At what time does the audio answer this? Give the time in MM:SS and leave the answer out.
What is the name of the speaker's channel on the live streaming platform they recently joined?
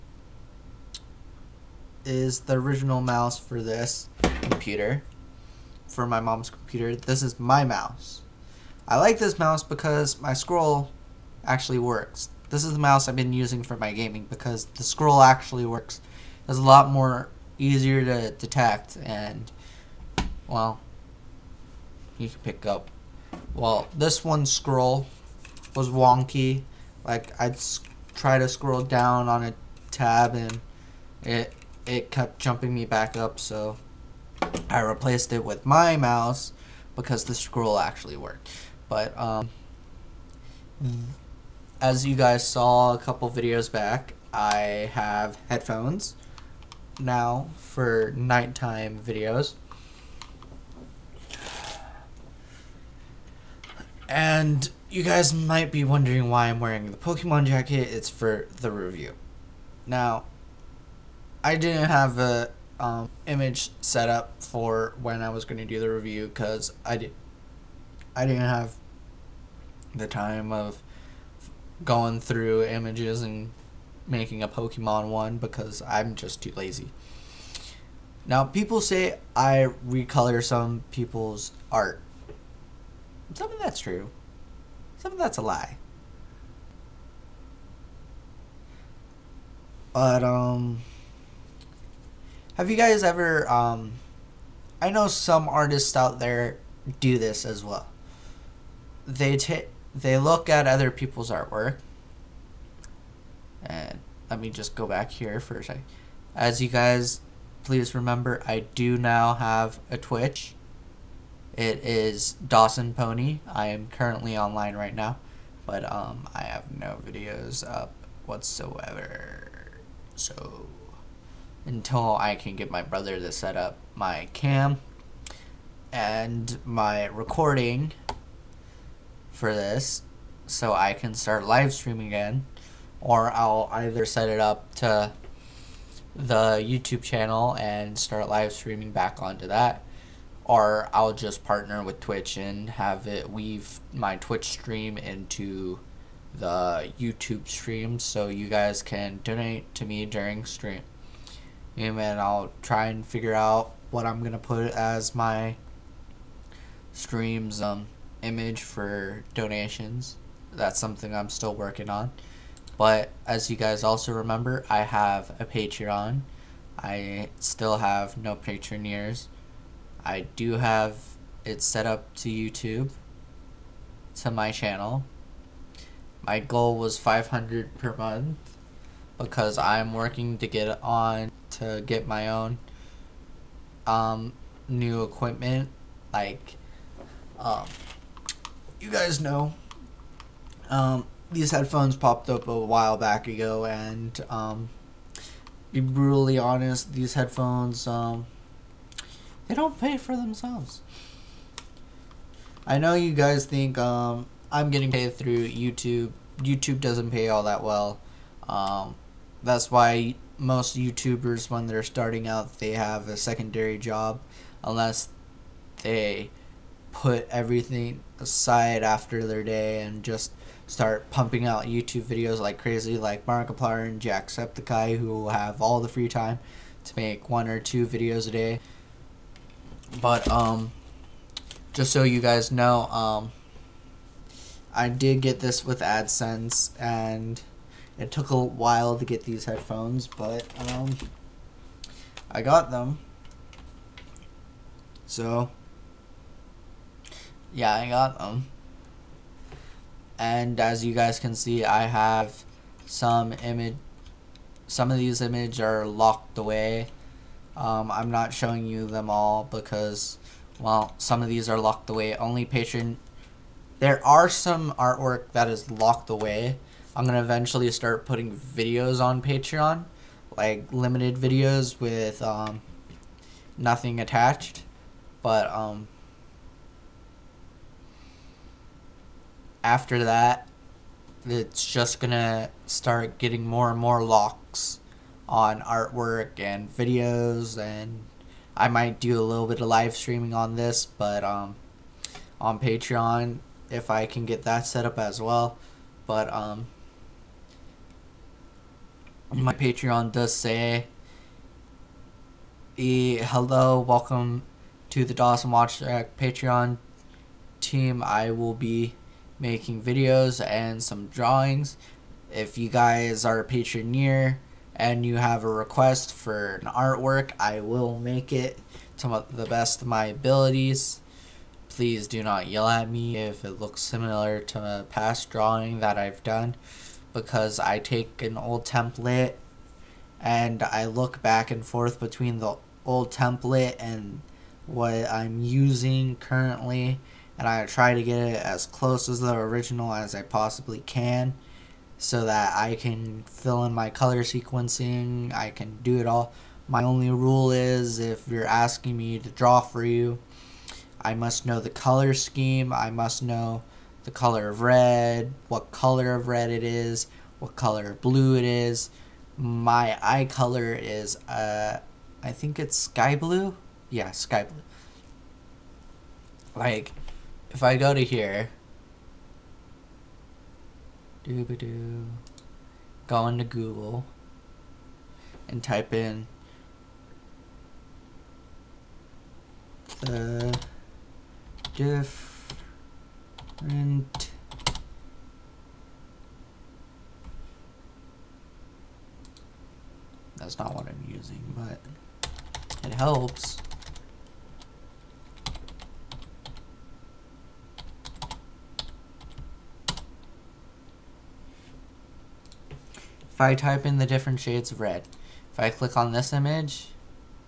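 01:52.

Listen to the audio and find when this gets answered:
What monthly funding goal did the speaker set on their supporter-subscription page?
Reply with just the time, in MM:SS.
02:56.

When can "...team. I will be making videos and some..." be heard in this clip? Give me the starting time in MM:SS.
05:07.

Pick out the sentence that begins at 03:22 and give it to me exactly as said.
I know you guys think um, I'm getting paid through YouTube.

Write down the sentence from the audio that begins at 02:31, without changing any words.
And then I'll try and figure out what I'm gonna put as my stream's um, image for donations.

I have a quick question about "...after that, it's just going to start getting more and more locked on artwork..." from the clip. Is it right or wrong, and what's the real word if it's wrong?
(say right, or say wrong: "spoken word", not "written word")
right.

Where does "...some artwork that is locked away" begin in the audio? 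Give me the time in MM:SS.
04:24.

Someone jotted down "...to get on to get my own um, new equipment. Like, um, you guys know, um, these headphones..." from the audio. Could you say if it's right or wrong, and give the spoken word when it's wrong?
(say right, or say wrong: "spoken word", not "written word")
right.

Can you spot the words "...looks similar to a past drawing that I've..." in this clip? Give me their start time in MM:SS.
05:23.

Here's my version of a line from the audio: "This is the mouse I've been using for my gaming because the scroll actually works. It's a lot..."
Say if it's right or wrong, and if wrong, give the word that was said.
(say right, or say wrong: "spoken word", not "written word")
right.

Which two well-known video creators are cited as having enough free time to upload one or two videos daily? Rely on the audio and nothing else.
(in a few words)
Markiplier and Jacksepticeye.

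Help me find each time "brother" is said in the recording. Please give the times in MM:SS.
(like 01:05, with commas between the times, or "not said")
02:02.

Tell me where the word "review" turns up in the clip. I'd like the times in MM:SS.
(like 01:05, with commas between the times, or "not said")
00:58, 01:05.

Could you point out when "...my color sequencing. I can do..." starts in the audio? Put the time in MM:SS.
05:43.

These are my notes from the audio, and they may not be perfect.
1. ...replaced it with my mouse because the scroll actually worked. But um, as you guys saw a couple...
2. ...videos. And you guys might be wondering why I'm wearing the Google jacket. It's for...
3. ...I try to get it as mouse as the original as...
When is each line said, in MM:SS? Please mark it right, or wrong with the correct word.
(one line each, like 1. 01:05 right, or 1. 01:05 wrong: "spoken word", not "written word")
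1. 00:34 right
2. 00:48 wrong: "Pokemon", not "Google"
3. 05:37 wrong: "close", not "mouse".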